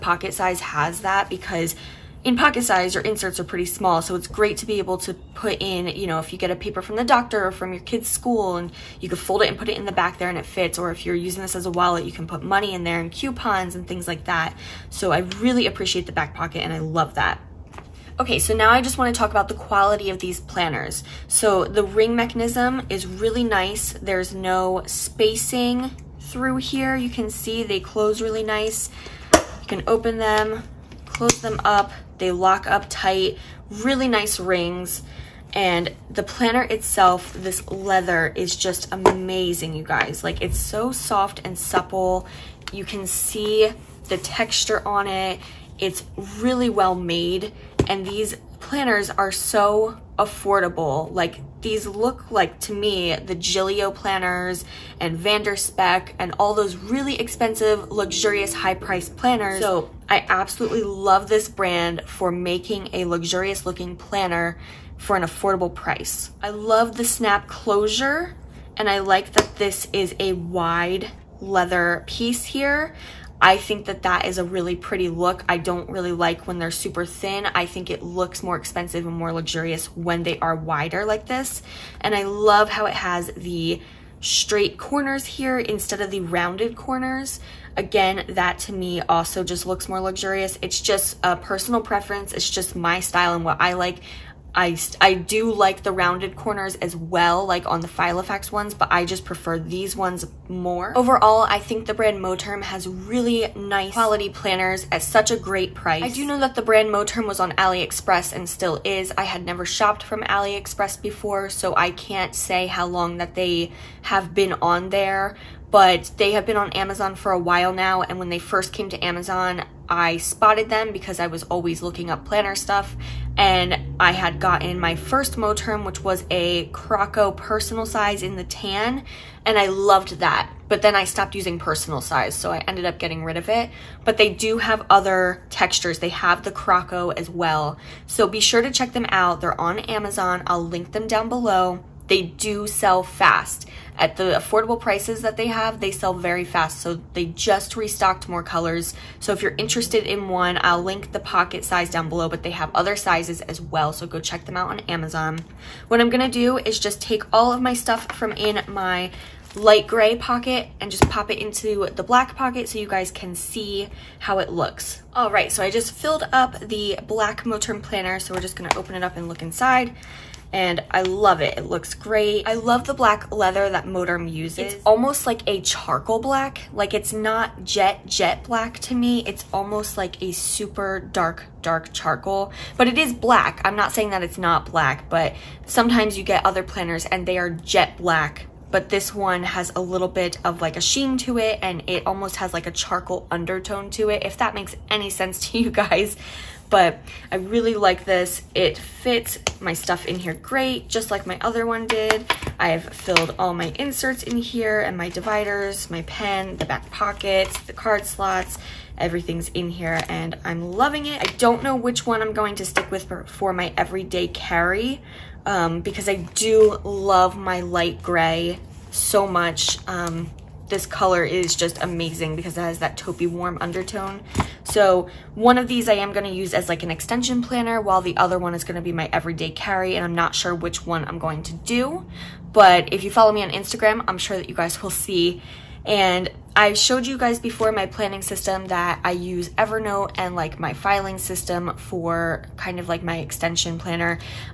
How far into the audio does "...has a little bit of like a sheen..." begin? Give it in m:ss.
3:09.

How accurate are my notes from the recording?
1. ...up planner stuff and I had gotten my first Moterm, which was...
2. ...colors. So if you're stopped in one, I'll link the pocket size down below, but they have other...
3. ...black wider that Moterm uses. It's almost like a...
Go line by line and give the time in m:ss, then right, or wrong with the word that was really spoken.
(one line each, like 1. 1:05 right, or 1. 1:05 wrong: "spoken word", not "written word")
1. 2:02 right
2. 2:28 wrong: "interested", not "stopped"
3. 2:52 wrong: "leather", not "wider".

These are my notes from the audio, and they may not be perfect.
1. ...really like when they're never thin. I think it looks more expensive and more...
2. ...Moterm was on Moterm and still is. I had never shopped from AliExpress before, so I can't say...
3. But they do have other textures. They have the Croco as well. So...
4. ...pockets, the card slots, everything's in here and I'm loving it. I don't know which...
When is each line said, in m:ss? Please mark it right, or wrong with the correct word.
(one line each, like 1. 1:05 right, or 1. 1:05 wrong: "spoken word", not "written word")
1. 1:15 wrong: "super", not "never"
2. 1:46 wrong: "AliExpress", not "Moterm"
3. 2:14 right
4. 3:26 right.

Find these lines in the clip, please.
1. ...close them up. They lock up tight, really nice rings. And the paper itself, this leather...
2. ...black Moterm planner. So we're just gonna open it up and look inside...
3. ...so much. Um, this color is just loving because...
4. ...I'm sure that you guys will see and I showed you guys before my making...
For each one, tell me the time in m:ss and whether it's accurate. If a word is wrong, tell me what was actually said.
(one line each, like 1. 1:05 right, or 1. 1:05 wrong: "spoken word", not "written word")
1. 0:31 wrong: "planner", not "paper"
2. 2:47 right
3. 3:38 wrong: "amazing", not "loving"
4. 3:54 wrong: "planning", not "making".